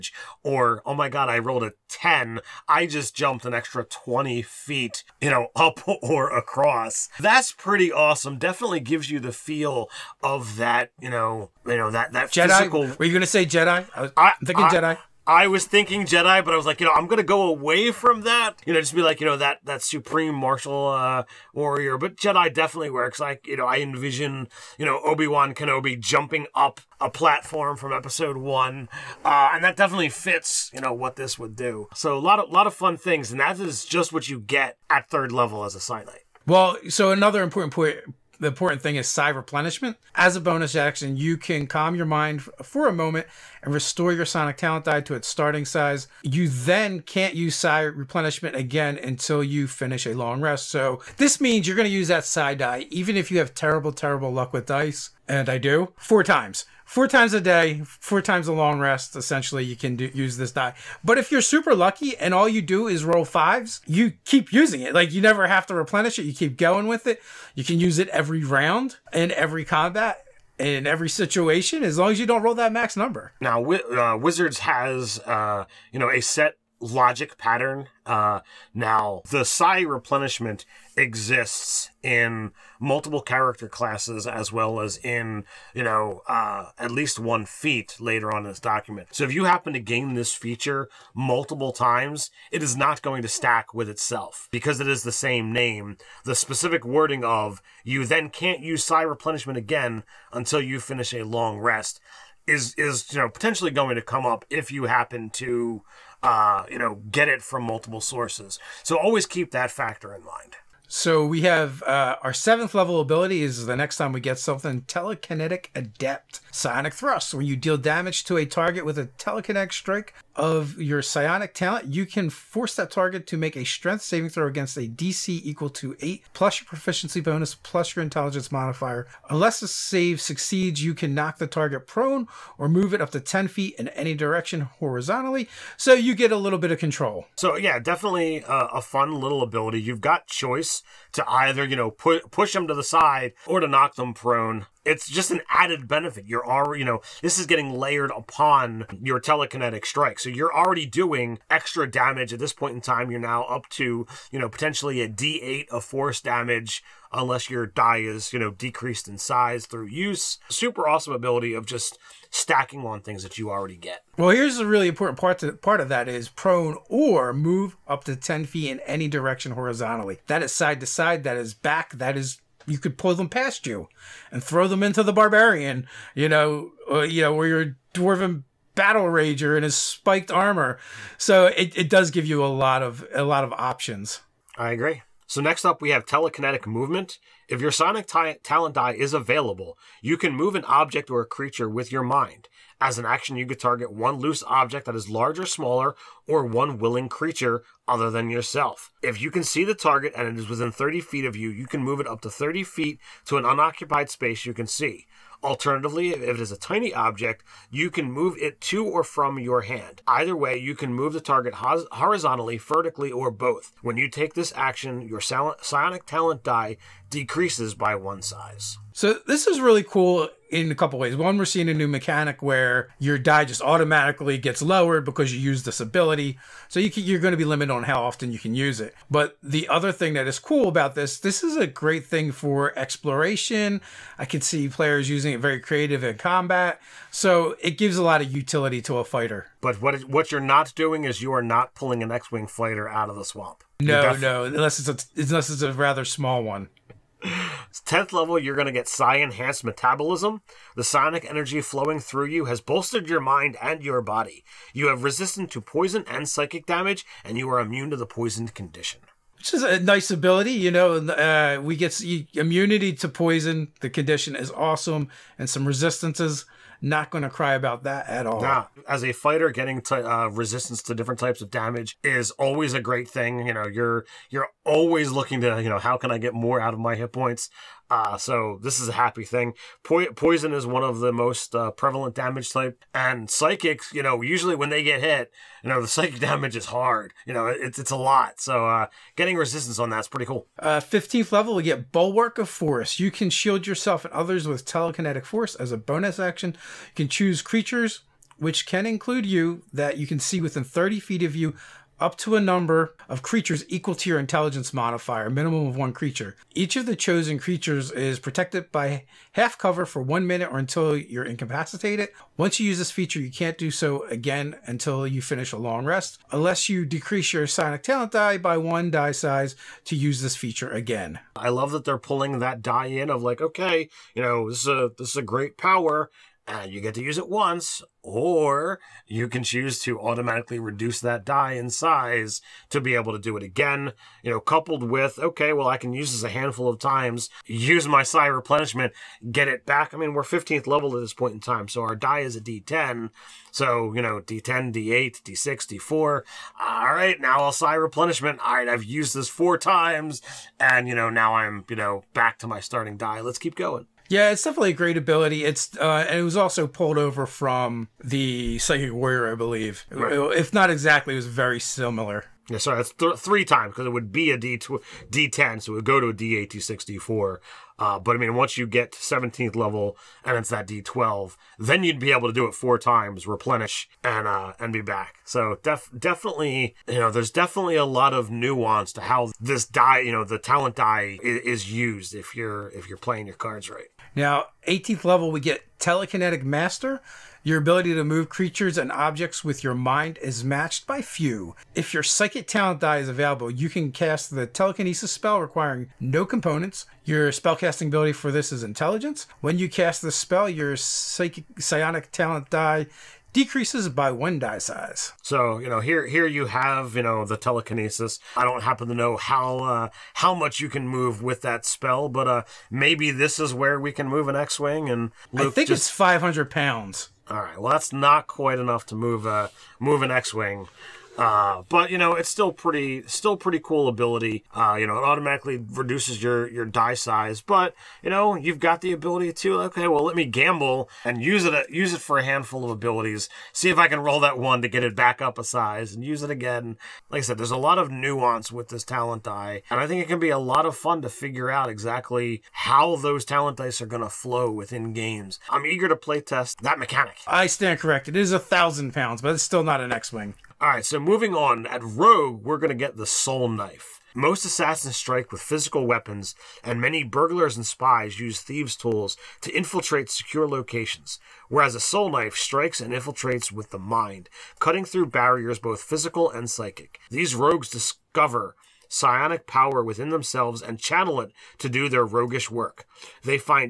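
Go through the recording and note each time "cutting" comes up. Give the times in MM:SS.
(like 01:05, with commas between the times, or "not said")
07:44.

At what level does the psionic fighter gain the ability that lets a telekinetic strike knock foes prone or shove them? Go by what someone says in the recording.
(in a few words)
7th.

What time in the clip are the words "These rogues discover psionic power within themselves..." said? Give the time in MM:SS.
07:47.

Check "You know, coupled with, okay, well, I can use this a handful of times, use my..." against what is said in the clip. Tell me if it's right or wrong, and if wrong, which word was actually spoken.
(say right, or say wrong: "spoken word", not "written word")
right.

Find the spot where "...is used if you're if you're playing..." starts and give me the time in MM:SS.
06:21.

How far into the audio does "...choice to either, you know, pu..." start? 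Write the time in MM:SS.
02:20.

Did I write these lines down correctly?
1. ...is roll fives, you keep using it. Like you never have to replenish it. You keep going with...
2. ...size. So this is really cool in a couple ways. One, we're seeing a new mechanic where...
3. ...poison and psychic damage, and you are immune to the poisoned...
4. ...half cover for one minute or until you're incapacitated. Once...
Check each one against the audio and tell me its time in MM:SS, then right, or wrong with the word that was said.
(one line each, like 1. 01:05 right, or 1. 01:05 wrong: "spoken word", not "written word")
1. 01:02 right
2. 03:38 right
3. 04:15 right
4. 05:09 right.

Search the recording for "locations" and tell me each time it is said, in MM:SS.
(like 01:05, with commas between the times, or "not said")
07:40.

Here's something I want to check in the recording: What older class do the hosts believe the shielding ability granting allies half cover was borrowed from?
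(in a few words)
Psychic Warrior.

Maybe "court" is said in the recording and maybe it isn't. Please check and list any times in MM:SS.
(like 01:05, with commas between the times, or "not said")
not said.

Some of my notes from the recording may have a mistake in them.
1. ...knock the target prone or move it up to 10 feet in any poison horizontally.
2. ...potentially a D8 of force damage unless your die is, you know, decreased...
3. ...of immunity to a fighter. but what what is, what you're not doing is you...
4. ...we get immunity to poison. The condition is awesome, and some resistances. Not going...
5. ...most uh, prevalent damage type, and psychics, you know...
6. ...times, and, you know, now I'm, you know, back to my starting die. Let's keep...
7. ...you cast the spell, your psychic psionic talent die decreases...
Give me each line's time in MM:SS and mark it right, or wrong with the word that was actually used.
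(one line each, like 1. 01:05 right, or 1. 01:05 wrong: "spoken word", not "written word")
1. 02:11 wrong: "direction", not "poison"
2. 02:34 right
3. 03:58 wrong: "utility", not "immunity"
4. 04:21 right
5. 04:41 right
6. 05:49 right
7. 06:39 right.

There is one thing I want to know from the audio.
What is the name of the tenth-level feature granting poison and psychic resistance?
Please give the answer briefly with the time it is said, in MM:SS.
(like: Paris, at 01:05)
Psi Enhanced Metabolism, at 04:08.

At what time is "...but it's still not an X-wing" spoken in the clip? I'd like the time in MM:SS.
07:29.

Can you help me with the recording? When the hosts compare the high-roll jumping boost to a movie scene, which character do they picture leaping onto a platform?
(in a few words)
Obi Wan Kenobi.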